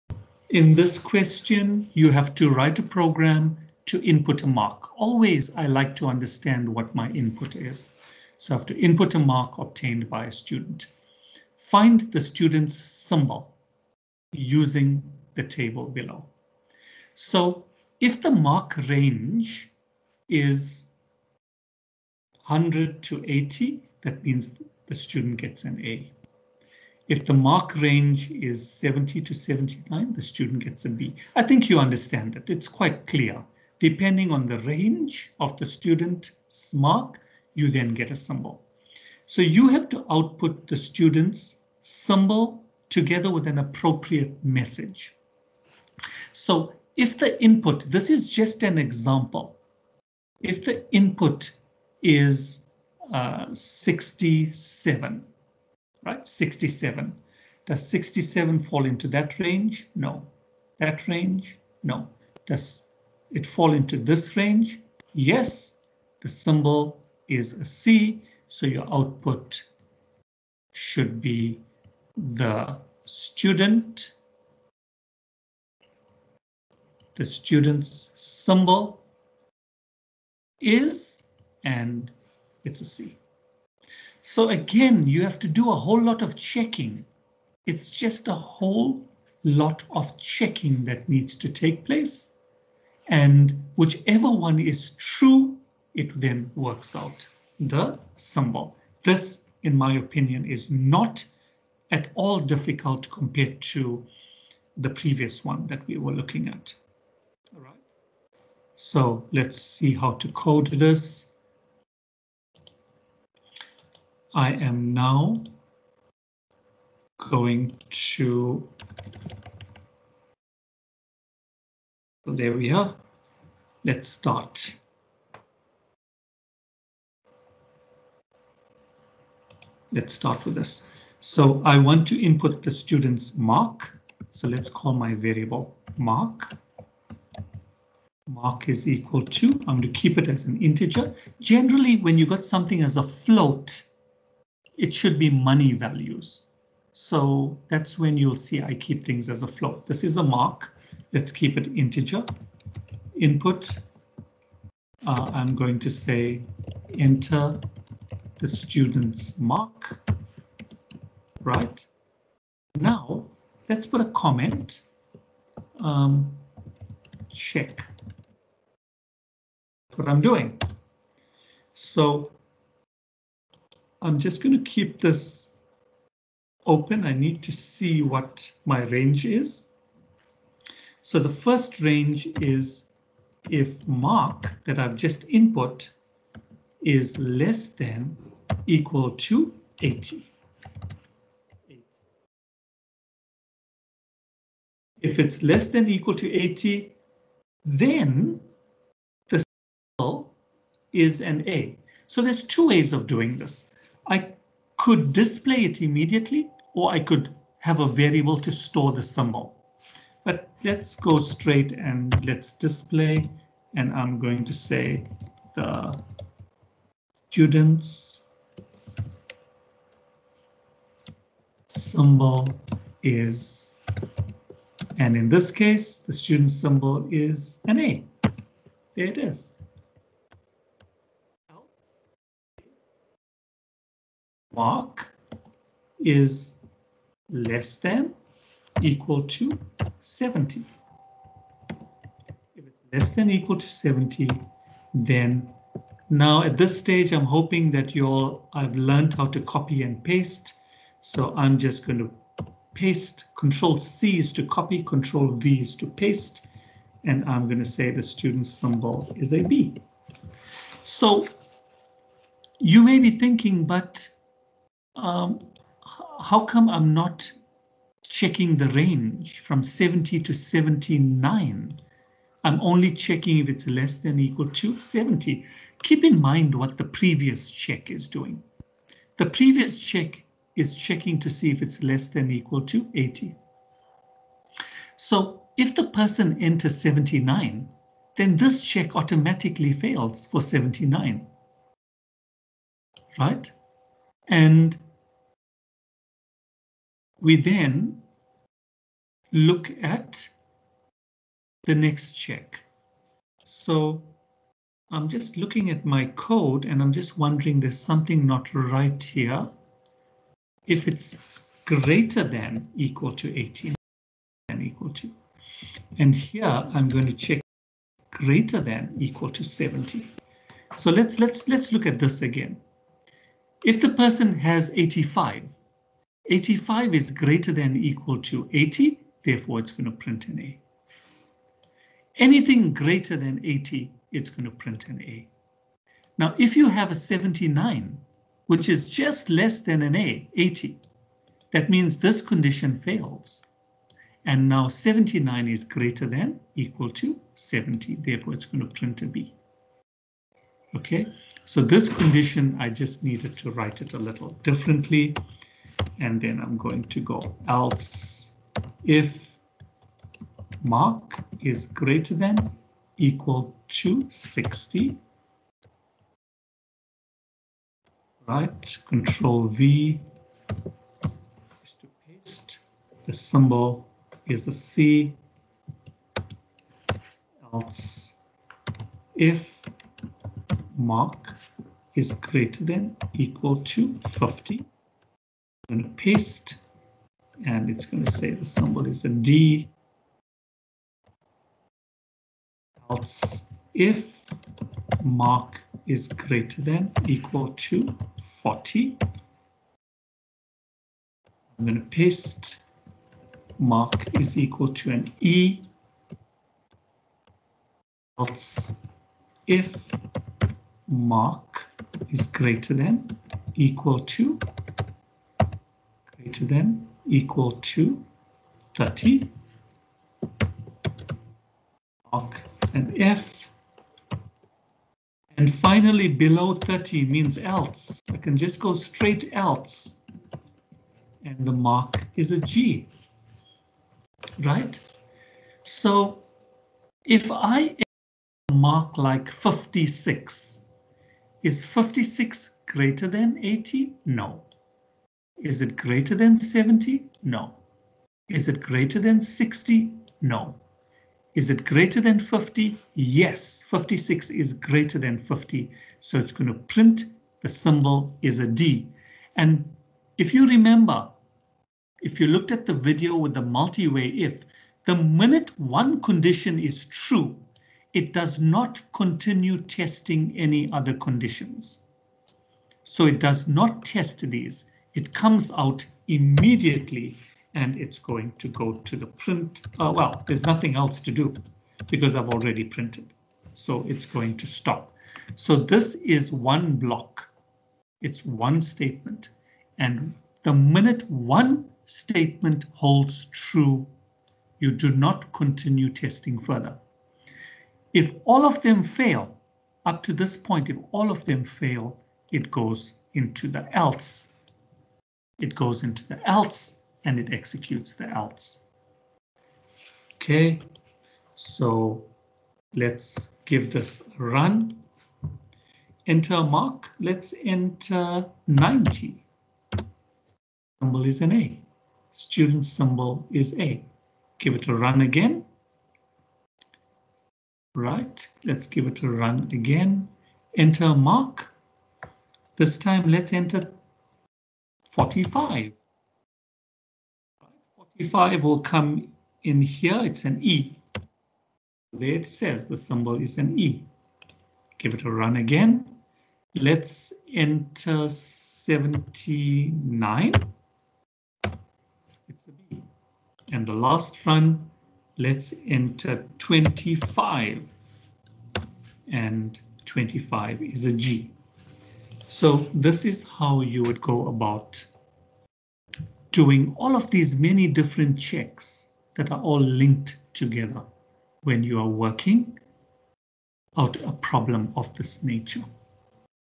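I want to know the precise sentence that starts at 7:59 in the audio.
Oh, well, there's nothing else to do because I've already printed.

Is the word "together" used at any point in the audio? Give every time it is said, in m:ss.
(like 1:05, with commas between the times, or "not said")
0:42, 9:30.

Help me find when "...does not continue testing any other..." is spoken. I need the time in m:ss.
7:48.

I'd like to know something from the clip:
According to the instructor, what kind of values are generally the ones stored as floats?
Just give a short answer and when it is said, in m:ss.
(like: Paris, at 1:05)
money values, at 2:25.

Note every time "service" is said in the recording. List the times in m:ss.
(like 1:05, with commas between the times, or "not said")
not said.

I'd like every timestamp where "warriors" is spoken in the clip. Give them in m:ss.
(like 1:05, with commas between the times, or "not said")
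not said.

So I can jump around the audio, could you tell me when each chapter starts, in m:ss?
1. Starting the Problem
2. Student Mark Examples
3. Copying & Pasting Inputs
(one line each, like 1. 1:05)
1. 2:09
2. 7:15
3. 5:51.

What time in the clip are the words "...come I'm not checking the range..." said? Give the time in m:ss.
4:26.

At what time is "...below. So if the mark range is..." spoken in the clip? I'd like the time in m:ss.
0:15.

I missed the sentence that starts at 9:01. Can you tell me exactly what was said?
There it says the symbol is an E.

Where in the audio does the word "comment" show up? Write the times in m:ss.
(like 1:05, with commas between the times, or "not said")
2:44.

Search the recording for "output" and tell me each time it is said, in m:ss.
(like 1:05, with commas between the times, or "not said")
0:40, 1:08.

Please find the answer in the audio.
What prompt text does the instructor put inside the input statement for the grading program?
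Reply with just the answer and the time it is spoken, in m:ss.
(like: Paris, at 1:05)
enter the student's mark, at 2:36.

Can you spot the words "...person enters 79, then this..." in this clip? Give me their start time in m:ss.
4:45.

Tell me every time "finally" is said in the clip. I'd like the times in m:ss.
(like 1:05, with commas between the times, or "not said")
7:05.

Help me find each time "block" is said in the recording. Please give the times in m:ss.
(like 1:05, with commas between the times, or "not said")
8:06.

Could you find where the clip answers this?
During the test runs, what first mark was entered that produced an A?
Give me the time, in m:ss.
8:38.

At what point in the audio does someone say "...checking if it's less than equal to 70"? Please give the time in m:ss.
4:32.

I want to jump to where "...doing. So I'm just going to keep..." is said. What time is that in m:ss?
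2:50.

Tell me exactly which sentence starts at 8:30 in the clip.
Okay, so let's give this a run.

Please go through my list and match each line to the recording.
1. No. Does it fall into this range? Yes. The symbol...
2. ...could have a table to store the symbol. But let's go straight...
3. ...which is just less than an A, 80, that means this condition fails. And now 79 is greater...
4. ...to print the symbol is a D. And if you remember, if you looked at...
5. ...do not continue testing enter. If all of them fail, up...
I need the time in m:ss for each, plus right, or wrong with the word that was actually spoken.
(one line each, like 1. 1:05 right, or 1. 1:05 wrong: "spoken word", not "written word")
1. 1:01 right
2. 3:26 wrong: "variable", not "table"
3. 5:38 right
4. 7:36 right
5. 8:14 wrong: "further", not "enter".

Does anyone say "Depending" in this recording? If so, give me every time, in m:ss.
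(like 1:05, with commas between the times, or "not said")
0:33.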